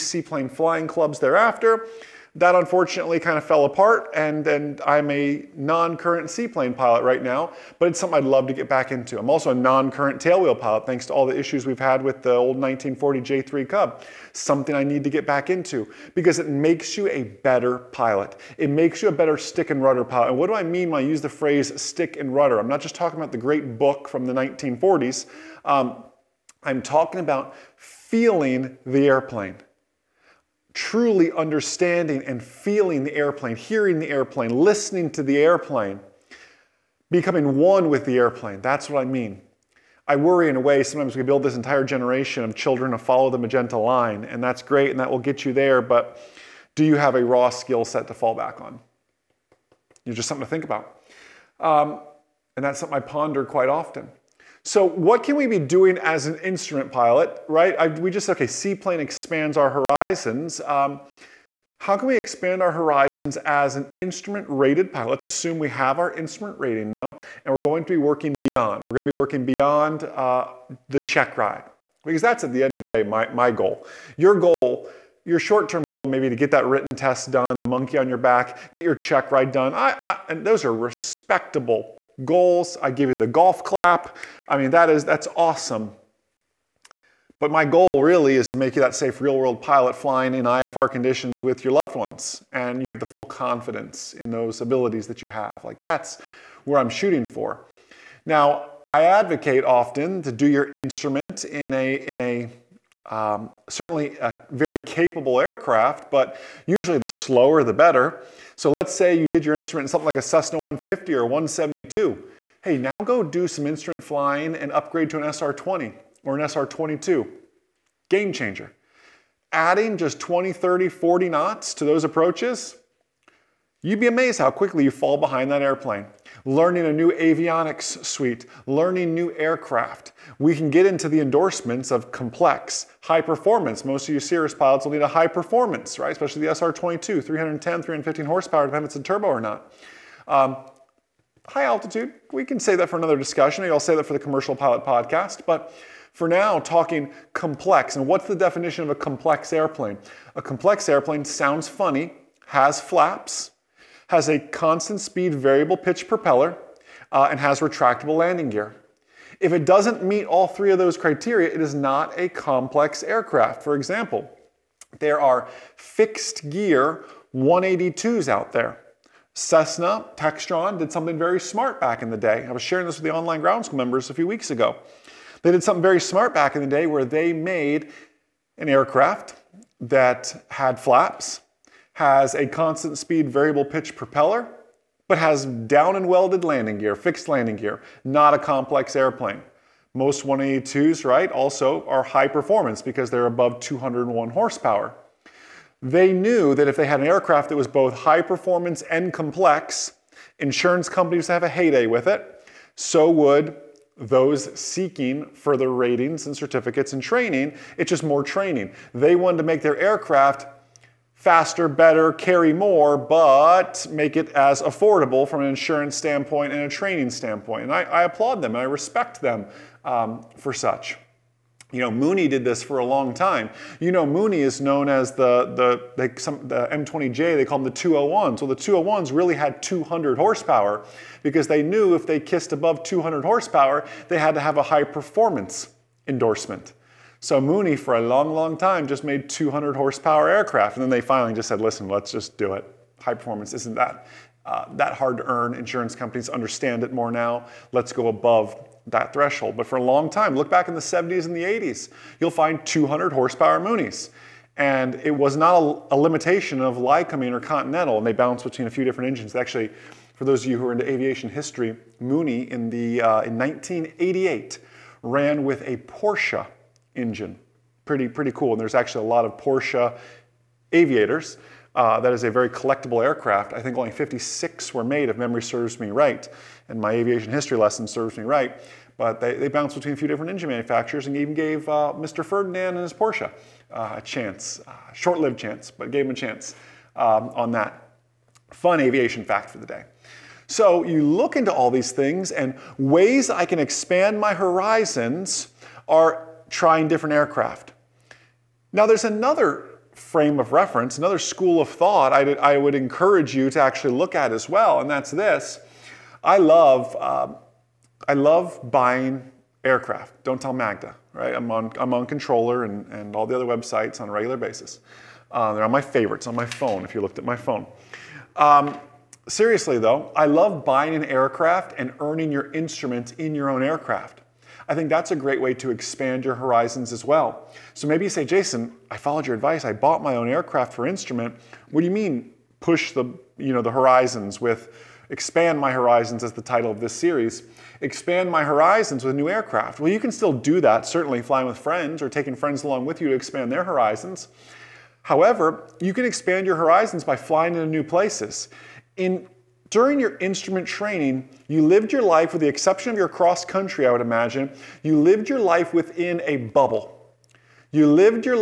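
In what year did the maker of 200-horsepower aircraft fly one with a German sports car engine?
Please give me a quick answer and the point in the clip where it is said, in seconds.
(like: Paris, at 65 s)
1988, at 263 s.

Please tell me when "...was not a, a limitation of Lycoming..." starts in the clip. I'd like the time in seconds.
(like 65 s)
255 s.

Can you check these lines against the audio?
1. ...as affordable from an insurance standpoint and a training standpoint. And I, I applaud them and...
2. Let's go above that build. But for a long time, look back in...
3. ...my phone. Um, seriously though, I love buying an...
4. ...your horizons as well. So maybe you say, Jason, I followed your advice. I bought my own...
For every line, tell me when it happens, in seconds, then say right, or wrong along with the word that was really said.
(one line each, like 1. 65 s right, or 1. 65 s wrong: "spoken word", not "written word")
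1. 214 s right
2. 247 s wrong: "threshold", not "build"
3. 317 s right
4. 326 s right.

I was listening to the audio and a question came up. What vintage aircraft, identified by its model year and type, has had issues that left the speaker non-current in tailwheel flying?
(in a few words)
1940 J3 Cub.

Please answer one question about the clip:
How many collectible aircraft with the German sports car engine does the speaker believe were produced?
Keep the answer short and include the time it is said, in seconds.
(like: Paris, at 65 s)
56, at 273 s.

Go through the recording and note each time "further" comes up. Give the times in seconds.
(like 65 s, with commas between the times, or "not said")
205 s.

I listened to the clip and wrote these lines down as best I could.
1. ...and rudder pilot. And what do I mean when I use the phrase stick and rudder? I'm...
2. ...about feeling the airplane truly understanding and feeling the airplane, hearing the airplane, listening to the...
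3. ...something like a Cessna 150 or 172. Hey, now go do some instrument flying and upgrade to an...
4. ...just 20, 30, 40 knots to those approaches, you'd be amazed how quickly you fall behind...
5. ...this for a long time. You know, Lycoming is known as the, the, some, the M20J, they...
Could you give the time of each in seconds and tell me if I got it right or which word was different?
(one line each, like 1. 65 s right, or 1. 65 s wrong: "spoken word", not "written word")
1. 19 s right
2. 27 s right
3. 109 s right
4. 119 s right
5. 222 s wrong: "Mooney", not "Lycoming".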